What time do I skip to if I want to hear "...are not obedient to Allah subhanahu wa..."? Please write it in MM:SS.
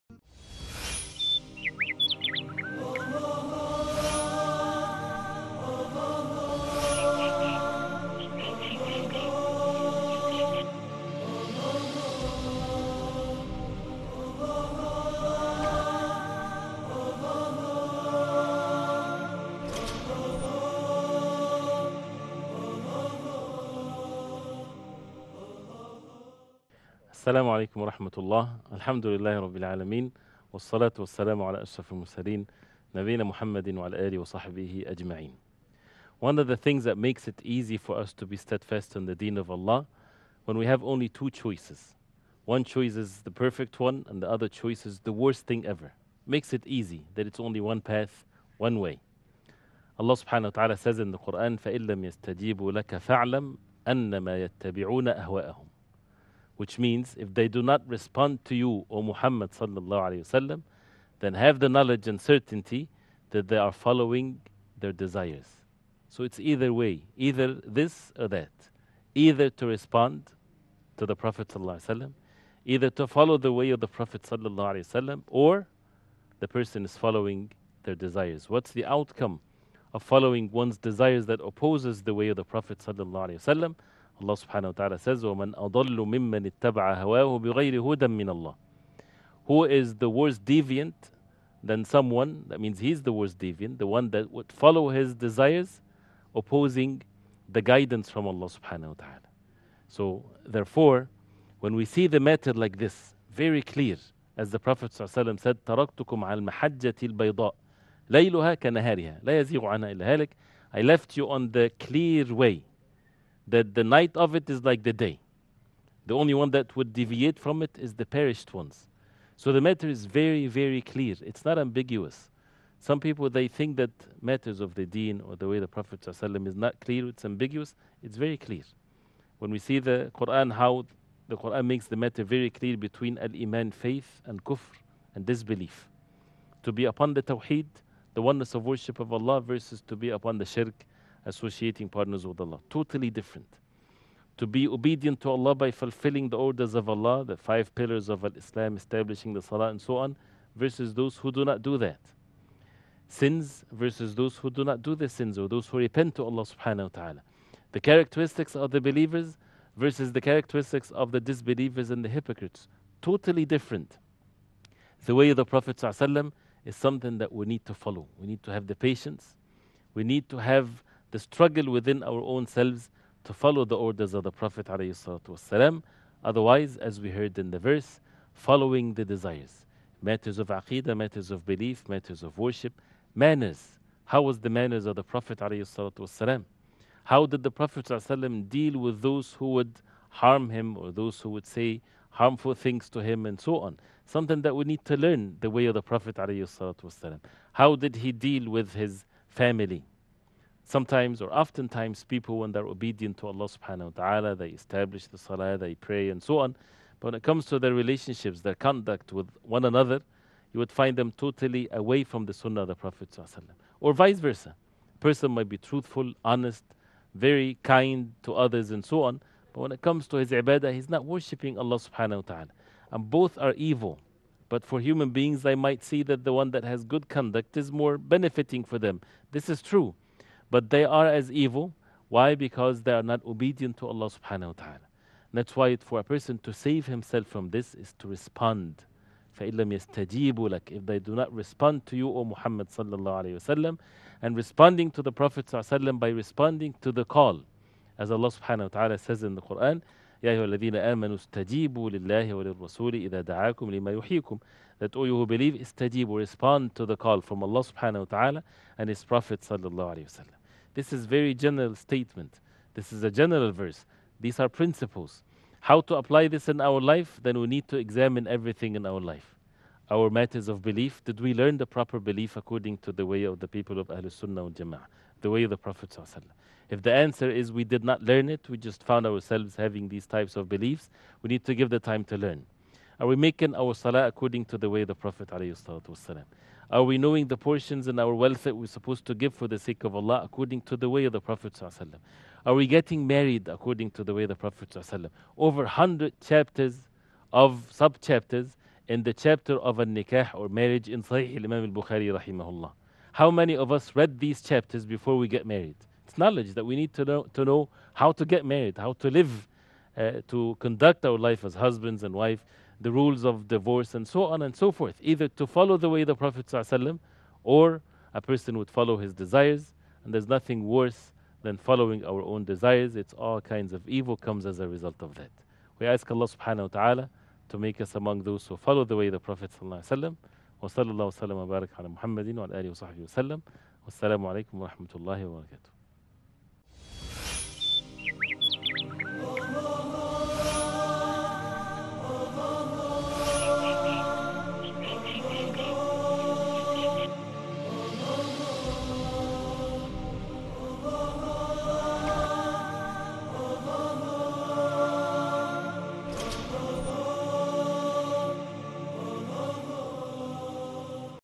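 03:52.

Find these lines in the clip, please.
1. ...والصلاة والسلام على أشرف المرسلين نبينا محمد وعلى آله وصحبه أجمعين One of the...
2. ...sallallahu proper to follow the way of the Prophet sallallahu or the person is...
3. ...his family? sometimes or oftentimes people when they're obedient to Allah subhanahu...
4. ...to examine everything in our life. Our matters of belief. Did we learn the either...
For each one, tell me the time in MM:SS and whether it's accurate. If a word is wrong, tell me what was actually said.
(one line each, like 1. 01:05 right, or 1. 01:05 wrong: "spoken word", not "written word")
1. 00:30 right
2. 01:11 wrong: "either", not "proper"
3. 03:18 right
4. 04:27 wrong: "proper", not "either".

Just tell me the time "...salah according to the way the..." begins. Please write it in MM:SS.
04:43.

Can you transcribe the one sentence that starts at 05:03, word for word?
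How many of us read these chapters before we get married?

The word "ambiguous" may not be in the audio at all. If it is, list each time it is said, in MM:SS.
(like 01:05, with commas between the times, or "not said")
02:01, 02:07.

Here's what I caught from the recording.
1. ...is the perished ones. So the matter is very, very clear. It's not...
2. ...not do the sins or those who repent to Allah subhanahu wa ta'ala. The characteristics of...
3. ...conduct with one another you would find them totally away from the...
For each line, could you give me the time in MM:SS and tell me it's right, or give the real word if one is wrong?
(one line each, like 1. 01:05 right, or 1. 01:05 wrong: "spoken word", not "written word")
1. 01:57 right
2. 02:34 right
3. 03:28 right.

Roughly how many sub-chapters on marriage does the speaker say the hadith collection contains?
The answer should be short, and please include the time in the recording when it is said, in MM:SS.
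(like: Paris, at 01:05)
Over 100, at 04:55.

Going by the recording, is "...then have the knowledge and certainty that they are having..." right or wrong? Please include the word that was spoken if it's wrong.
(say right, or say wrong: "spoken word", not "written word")
wrong: "following", not "having".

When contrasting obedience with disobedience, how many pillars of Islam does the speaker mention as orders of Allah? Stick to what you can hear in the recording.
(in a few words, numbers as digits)
5.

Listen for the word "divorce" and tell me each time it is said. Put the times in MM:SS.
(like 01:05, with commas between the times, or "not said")
05:13.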